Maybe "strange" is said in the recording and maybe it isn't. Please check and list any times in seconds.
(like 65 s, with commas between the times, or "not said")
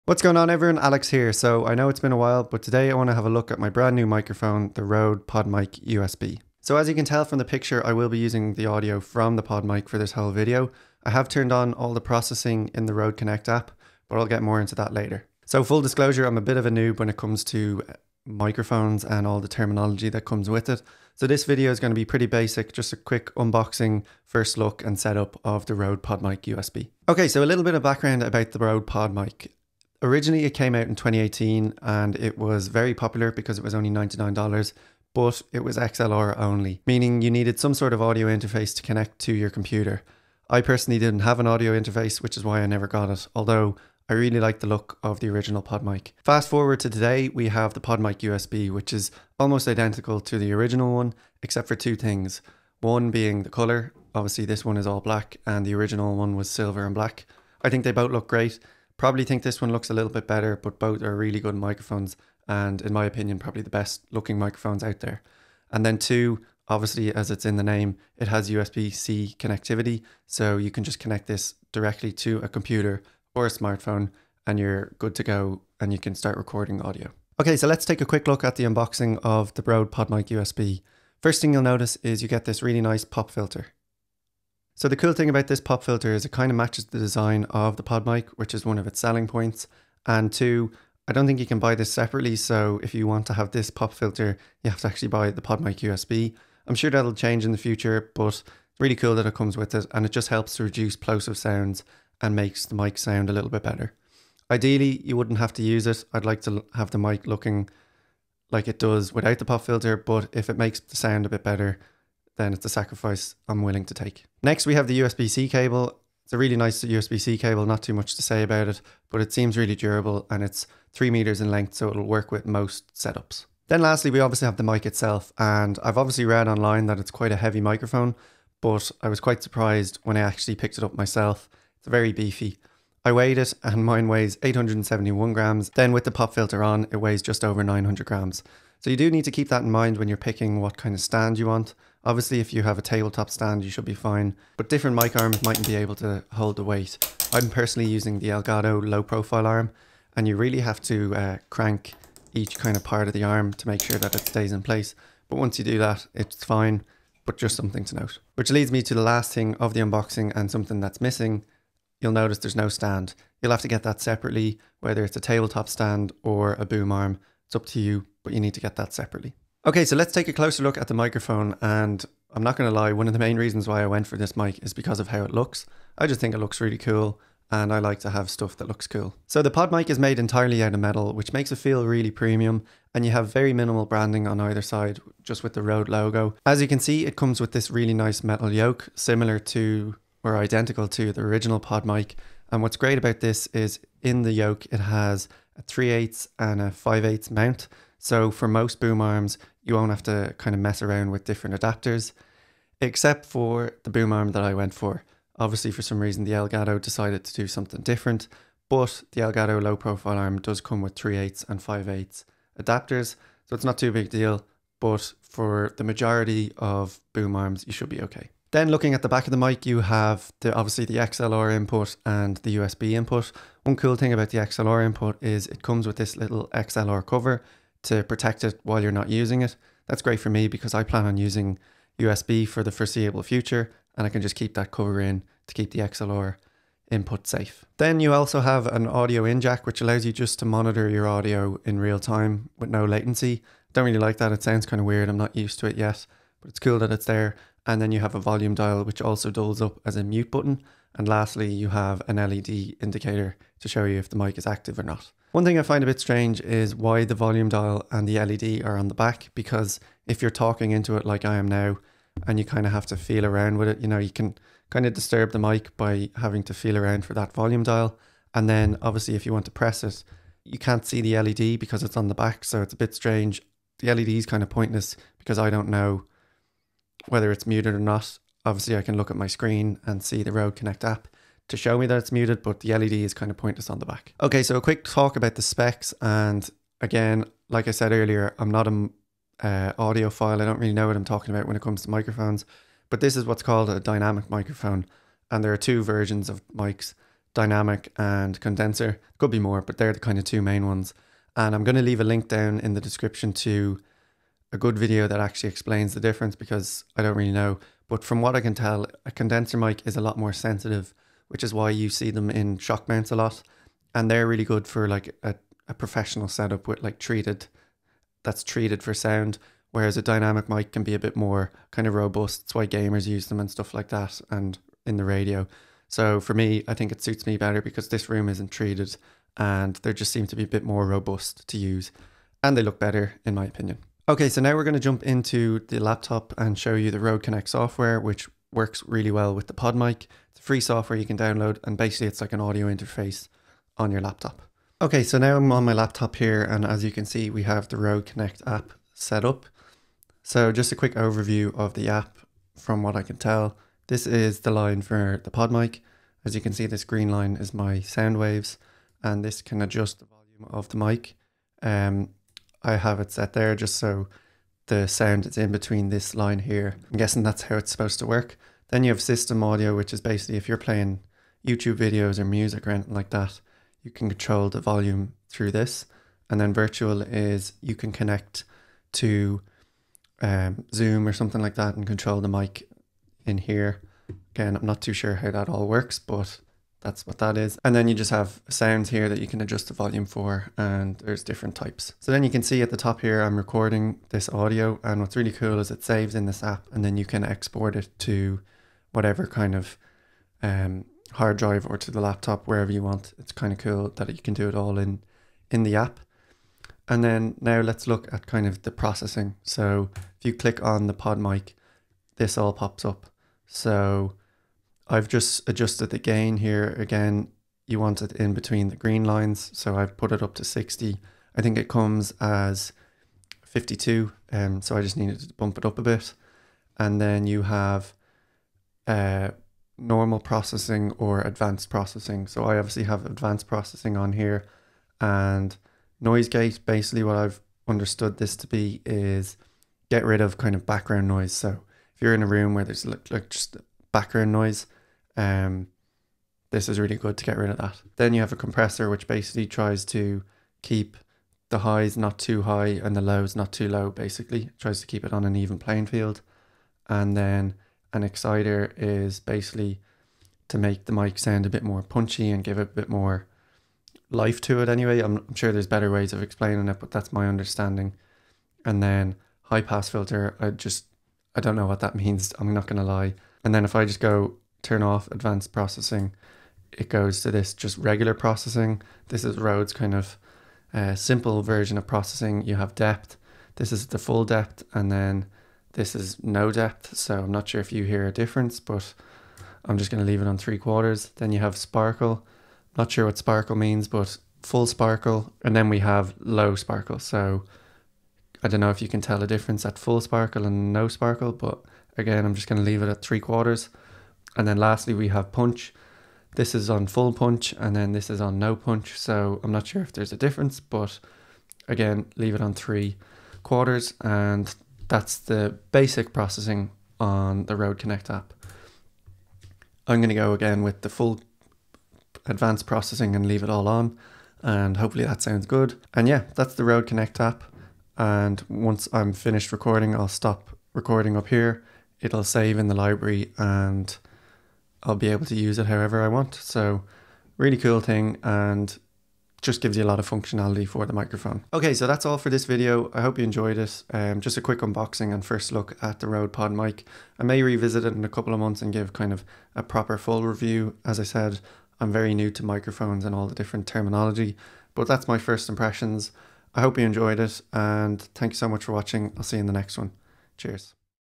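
256 s, 272 s.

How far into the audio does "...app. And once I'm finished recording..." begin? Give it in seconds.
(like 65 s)
527 s.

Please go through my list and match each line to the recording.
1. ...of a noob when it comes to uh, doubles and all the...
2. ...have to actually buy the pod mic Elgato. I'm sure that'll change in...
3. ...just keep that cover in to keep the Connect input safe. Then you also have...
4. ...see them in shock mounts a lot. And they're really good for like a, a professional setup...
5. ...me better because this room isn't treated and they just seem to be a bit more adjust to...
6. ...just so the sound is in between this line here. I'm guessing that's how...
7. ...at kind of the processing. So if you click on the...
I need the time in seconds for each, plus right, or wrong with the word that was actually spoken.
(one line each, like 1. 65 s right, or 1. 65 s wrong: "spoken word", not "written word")
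1. 16 s wrong: "microphones", not "doubles"
2. 94 s wrong: "USB", not "Elgato"
3. 234 s wrong: "XLR", not "Connect"
4. 311 s right
5. 327 s wrong: "robust", not "adjust"
6. 363 s right
7. 408 s right.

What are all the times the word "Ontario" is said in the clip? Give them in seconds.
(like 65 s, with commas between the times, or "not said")
not said.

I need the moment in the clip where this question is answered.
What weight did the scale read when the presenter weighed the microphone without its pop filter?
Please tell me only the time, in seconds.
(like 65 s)
134 s.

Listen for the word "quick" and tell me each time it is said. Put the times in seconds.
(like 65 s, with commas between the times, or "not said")
22 s, 78 s, 284 s, 350 s, 544 s.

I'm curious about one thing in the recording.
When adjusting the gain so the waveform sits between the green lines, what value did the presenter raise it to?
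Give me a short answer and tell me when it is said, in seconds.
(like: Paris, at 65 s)
60, at 420 s.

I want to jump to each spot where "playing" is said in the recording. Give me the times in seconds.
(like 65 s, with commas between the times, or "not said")
370 s, 455 s.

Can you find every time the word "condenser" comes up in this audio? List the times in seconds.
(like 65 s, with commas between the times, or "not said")
298 s, 309 s.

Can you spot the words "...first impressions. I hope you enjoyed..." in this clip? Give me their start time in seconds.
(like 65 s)
555 s.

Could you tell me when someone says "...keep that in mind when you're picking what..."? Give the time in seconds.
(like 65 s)
139 s.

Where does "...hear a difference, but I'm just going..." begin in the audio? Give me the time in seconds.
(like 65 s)
487 s.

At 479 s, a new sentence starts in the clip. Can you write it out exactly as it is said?
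This is Rode's kind of uh, simple version of processing.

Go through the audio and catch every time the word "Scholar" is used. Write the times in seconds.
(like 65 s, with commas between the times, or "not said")
not said.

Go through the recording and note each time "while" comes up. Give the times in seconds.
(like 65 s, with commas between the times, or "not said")
2 s, 228 s.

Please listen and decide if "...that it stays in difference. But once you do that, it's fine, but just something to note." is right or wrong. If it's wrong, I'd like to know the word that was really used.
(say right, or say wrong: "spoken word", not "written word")
wrong: "place", not "difference".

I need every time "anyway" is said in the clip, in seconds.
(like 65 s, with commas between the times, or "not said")
464 s.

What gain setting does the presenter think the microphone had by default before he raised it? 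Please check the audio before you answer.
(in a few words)
52.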